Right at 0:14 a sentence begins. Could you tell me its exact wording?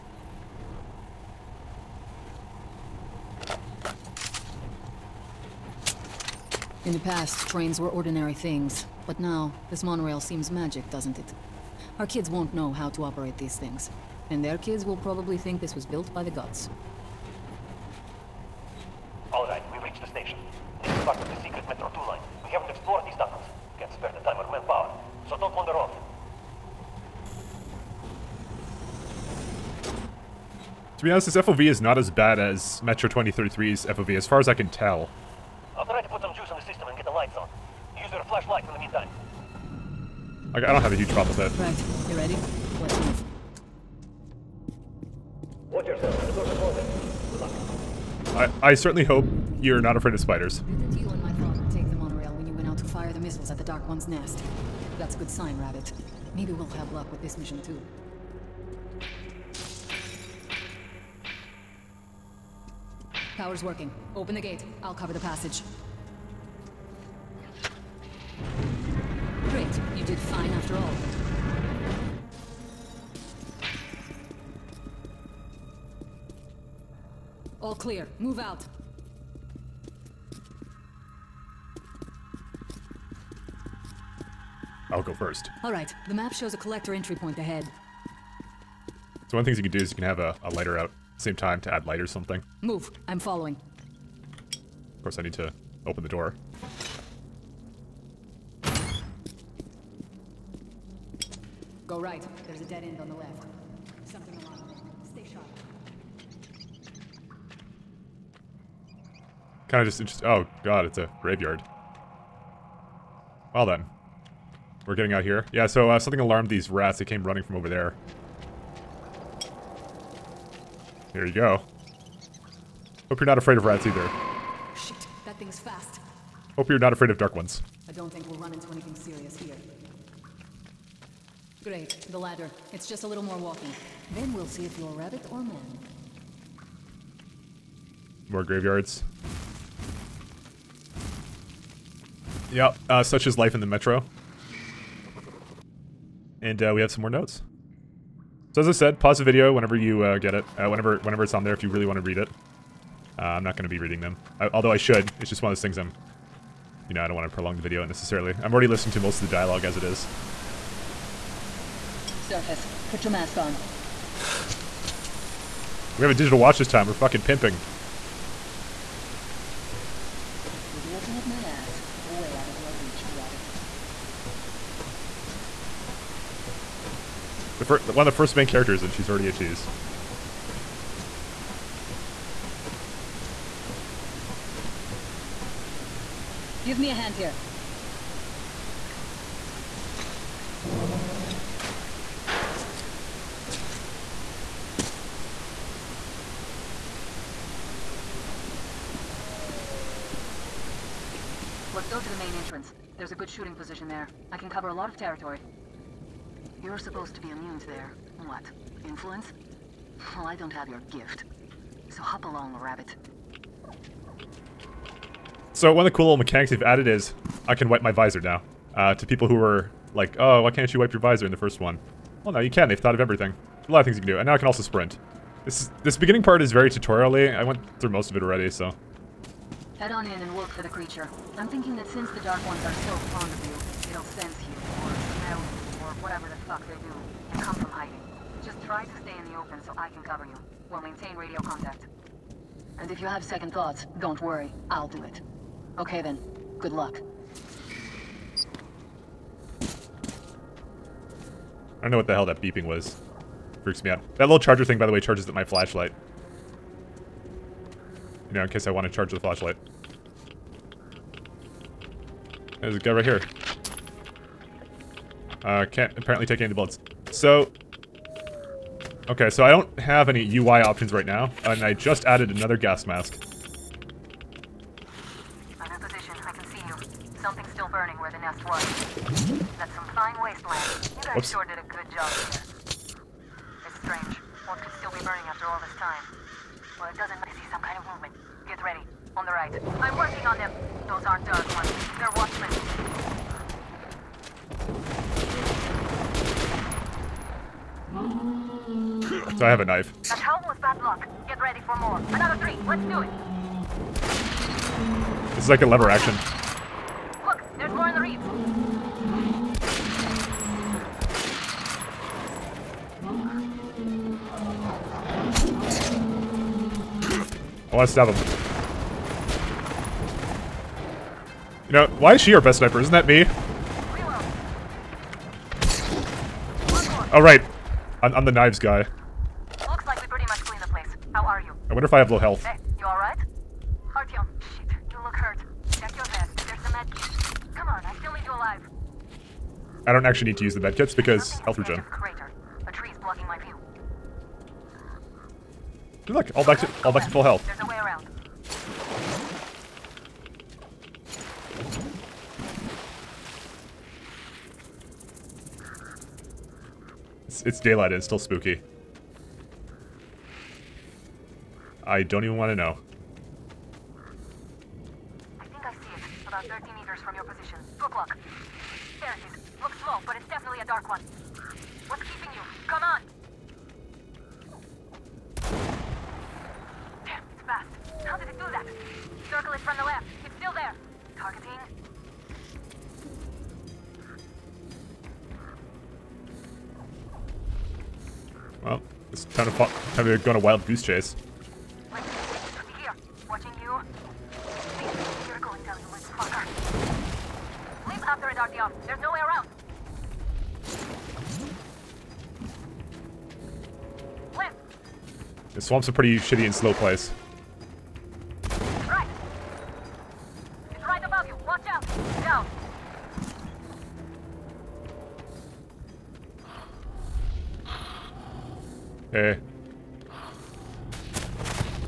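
And their kids will probably think this was built by the gods.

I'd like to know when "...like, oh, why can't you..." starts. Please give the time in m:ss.
3:39.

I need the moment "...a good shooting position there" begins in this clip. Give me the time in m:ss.
3:23.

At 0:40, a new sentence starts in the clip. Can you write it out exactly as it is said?
I, I don't have a huge problem with it.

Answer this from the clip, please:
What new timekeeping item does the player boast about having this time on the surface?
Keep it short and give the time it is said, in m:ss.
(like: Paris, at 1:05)
Digital watch, at 2:46.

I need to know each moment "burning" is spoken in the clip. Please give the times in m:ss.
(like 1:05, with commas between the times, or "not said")
4:37, 4:45.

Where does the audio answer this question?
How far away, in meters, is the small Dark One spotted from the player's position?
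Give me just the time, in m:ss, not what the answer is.
6:06.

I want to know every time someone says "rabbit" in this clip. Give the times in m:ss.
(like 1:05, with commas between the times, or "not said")
0:55, 2:14, 2:53, 3:32.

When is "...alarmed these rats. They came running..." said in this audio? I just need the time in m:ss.
1:56.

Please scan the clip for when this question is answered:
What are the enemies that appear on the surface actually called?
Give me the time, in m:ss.
4:52.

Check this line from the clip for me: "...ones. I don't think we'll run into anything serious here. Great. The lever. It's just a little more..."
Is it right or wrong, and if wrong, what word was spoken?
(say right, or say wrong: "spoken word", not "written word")
wrong: "ladder", not "lever".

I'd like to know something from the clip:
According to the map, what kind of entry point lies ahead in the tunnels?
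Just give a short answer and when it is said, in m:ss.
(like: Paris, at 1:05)
Collector entry point, at 1:26.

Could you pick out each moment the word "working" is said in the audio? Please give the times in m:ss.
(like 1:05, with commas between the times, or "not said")
1:03, 4:49.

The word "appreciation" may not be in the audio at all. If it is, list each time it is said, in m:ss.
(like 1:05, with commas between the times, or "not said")
not said.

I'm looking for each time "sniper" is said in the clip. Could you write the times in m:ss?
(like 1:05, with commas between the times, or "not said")
5:22.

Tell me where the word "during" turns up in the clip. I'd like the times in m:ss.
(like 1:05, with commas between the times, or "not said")
not said.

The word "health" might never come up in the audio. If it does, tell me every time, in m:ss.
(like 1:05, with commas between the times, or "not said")
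5:32, 5:41, 5:47.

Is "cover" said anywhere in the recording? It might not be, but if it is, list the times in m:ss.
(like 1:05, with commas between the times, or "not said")
1:04, 3:24, 4:00.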